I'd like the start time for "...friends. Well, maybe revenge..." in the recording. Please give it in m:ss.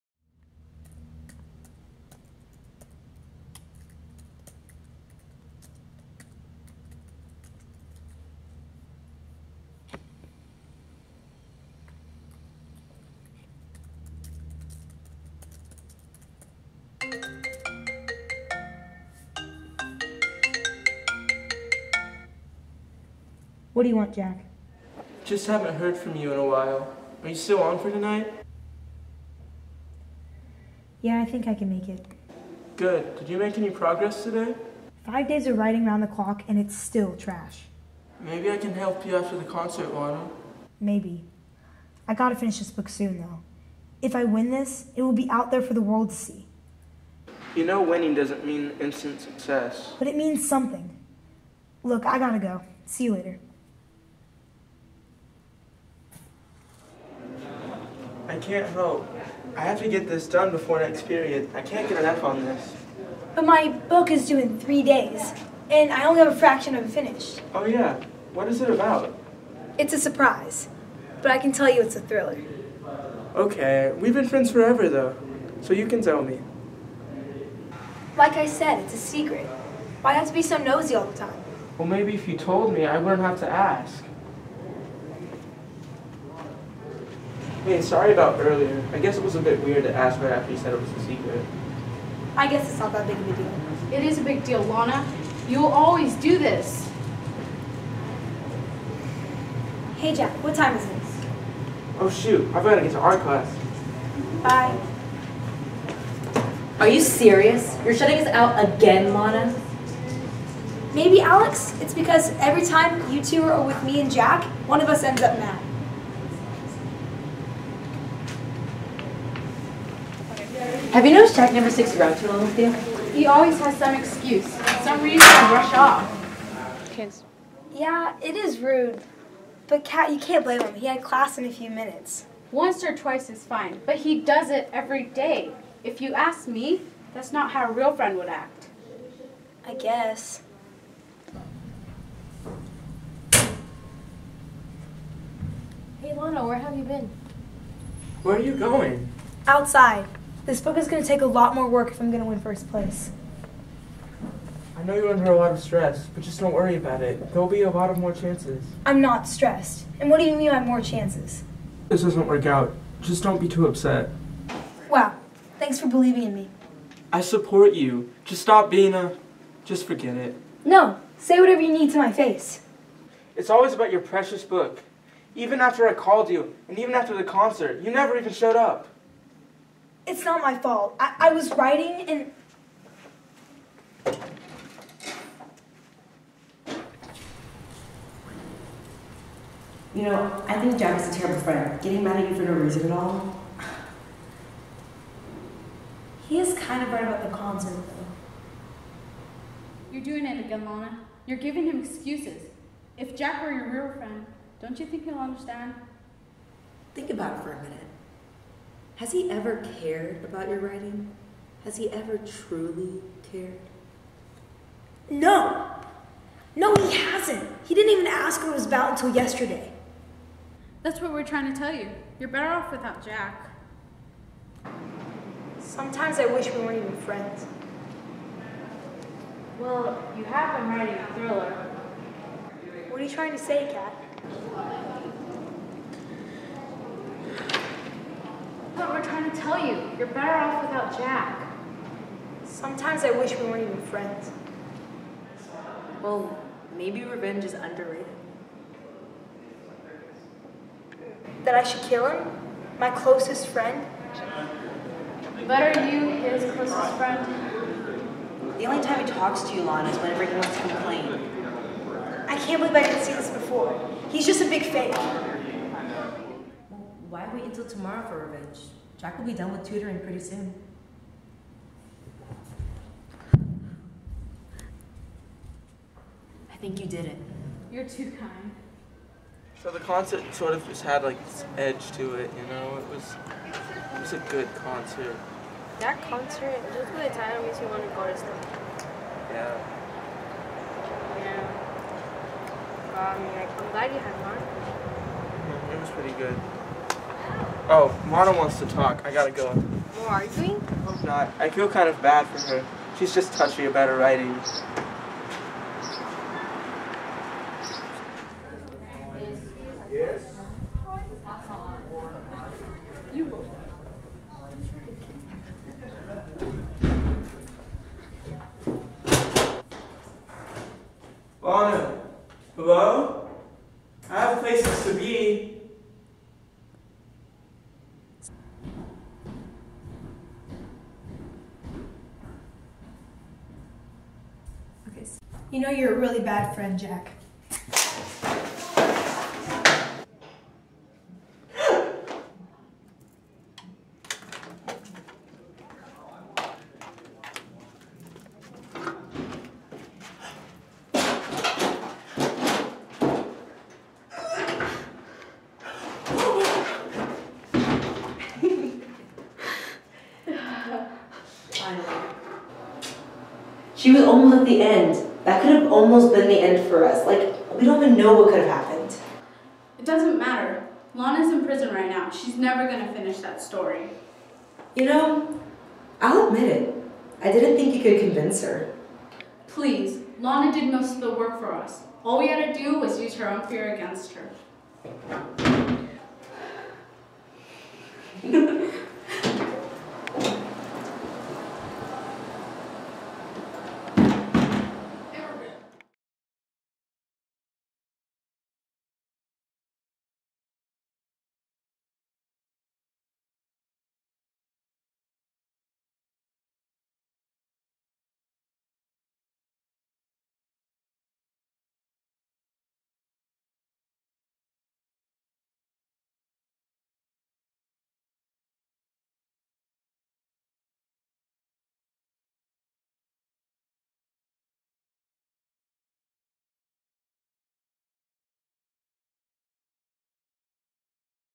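4:03.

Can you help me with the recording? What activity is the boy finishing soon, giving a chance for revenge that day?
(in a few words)
Tutoring.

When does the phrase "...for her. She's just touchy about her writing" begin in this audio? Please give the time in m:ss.
5:02.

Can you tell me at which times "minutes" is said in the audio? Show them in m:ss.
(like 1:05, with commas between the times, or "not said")
2:11, 3:27.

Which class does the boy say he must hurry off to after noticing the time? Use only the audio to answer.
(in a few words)
Art class.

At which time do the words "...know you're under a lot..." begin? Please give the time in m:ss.
2:34.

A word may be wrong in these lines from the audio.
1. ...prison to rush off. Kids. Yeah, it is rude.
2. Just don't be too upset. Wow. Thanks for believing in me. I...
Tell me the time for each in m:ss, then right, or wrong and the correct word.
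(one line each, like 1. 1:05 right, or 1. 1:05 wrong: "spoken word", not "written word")
1. 2:05 wrong: "reason", not "prison"
2. 2:43 right.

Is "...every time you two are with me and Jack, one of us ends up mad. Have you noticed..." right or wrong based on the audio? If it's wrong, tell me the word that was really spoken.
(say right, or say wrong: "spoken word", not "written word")
right.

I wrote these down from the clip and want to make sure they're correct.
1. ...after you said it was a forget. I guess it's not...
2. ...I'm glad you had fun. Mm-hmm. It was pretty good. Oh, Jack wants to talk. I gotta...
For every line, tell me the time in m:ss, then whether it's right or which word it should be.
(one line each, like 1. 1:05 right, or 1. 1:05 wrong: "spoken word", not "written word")
1. 1:30 wrong: "secret", not "forget"
2. 4:53 wrong: "Lana", not "Jack".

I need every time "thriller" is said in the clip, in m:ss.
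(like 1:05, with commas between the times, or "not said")
1:12, 3:51.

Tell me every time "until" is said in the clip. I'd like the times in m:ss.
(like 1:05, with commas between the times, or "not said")
3:38, 4:27.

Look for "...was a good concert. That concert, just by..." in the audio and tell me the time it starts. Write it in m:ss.
4:44.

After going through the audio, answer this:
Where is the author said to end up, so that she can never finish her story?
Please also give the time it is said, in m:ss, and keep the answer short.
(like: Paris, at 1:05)
Prison, at 6:11.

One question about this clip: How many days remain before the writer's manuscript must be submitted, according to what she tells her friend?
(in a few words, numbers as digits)
3.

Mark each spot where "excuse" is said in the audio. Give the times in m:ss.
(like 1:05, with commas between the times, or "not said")
2:03, 3:21.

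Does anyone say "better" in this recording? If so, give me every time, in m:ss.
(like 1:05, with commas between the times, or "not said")
3:42, 4:00.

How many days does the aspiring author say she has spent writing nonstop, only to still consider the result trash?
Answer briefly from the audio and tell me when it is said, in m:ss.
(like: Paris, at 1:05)
5, at 0:35.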